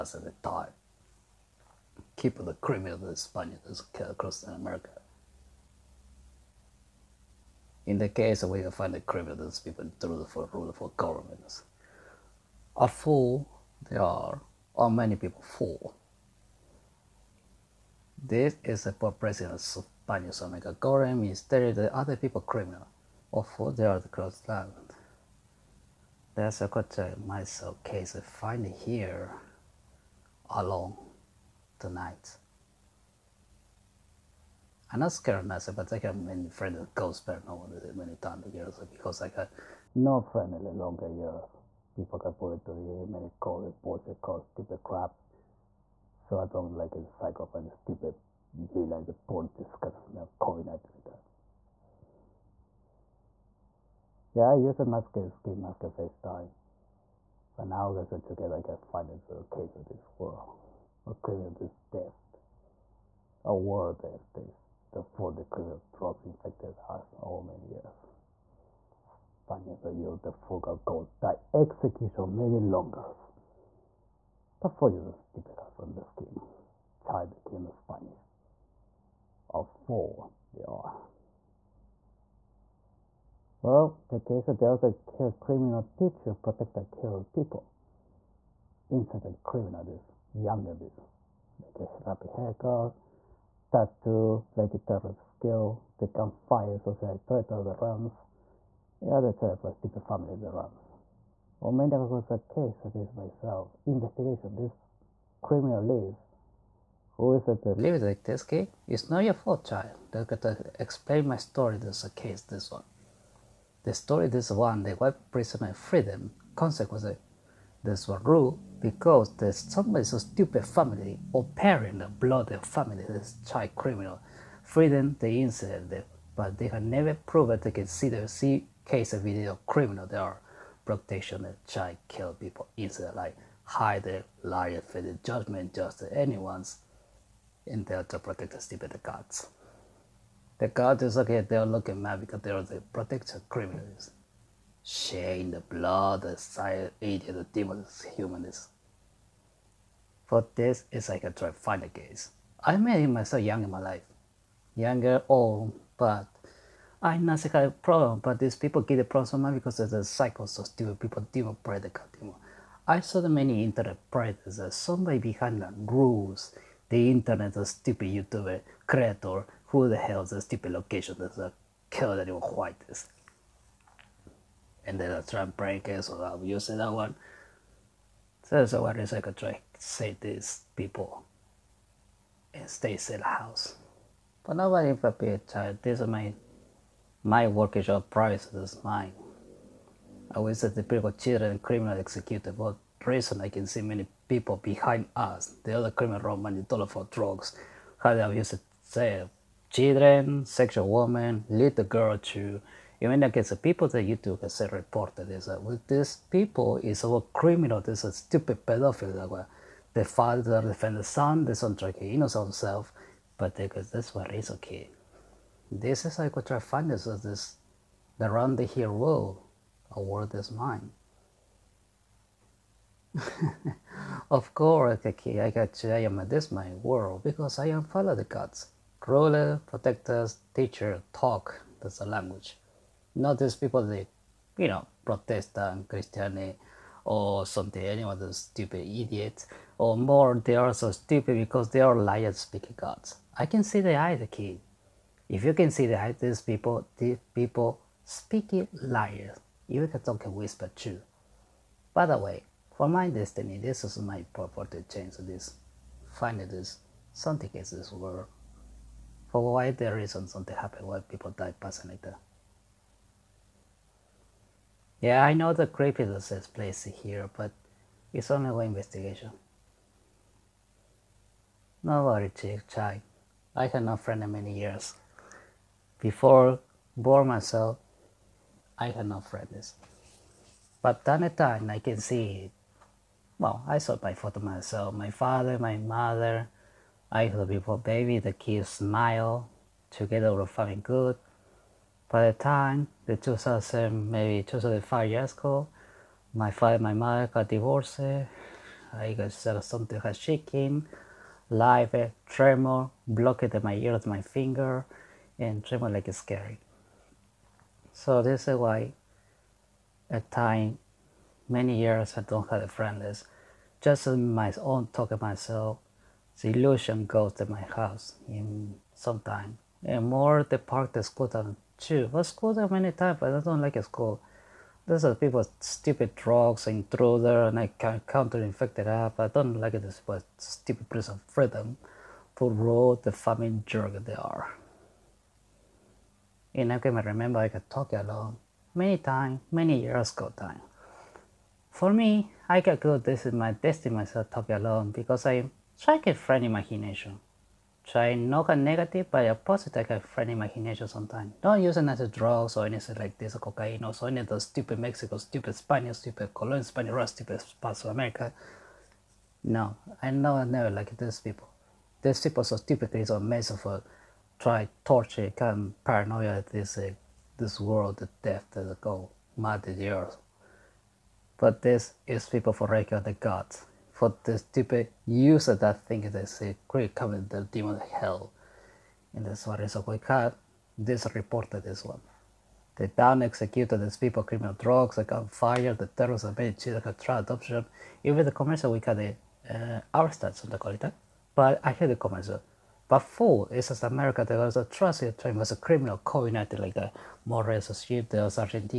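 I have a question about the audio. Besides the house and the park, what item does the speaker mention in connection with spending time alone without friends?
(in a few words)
scooter.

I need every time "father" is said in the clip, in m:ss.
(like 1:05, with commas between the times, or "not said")
3:30, 4:45, 4:56.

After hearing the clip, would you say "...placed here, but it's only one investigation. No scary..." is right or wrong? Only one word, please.
wrong.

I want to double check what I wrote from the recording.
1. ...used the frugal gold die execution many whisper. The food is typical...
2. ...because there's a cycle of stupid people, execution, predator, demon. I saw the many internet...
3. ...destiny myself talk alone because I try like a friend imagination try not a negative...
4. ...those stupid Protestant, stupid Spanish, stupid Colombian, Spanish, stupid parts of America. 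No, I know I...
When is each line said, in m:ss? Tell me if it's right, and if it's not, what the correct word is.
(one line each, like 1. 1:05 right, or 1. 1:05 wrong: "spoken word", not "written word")
1. 1:09 wrong: "longer", not "whisper"
2. 2:39 wrong: "demon", not "execution"
3. 5:43 right
4. 5:54 wrong: "Mexico", not "Protestant".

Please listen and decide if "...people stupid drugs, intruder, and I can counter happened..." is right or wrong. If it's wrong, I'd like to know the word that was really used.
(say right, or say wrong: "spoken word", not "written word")
wrong: "infected", not "happened".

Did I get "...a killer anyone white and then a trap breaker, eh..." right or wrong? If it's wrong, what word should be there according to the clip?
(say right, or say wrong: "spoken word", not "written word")
right.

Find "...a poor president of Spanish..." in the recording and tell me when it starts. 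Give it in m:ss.
0:18.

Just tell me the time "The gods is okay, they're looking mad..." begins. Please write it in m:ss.
2:20.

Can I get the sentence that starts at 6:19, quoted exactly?
In this one is a quick This reported this one.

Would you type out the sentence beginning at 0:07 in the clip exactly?
In the case where you find the criminals, people through the rule for governments.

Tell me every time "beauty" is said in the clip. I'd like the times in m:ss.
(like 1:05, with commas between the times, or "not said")
not said.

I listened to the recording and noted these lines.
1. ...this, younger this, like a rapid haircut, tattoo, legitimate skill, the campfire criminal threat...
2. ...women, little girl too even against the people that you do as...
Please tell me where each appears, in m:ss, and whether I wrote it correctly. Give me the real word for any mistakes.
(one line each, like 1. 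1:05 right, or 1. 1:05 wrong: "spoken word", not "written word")
1. 1:29 wrong: "social", not "criminal"
2. 3:20 right.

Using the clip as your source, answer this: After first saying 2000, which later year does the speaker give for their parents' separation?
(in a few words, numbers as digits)
2005.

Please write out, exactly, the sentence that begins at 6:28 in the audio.
Even the commercial we got the uh, our stats on the quality.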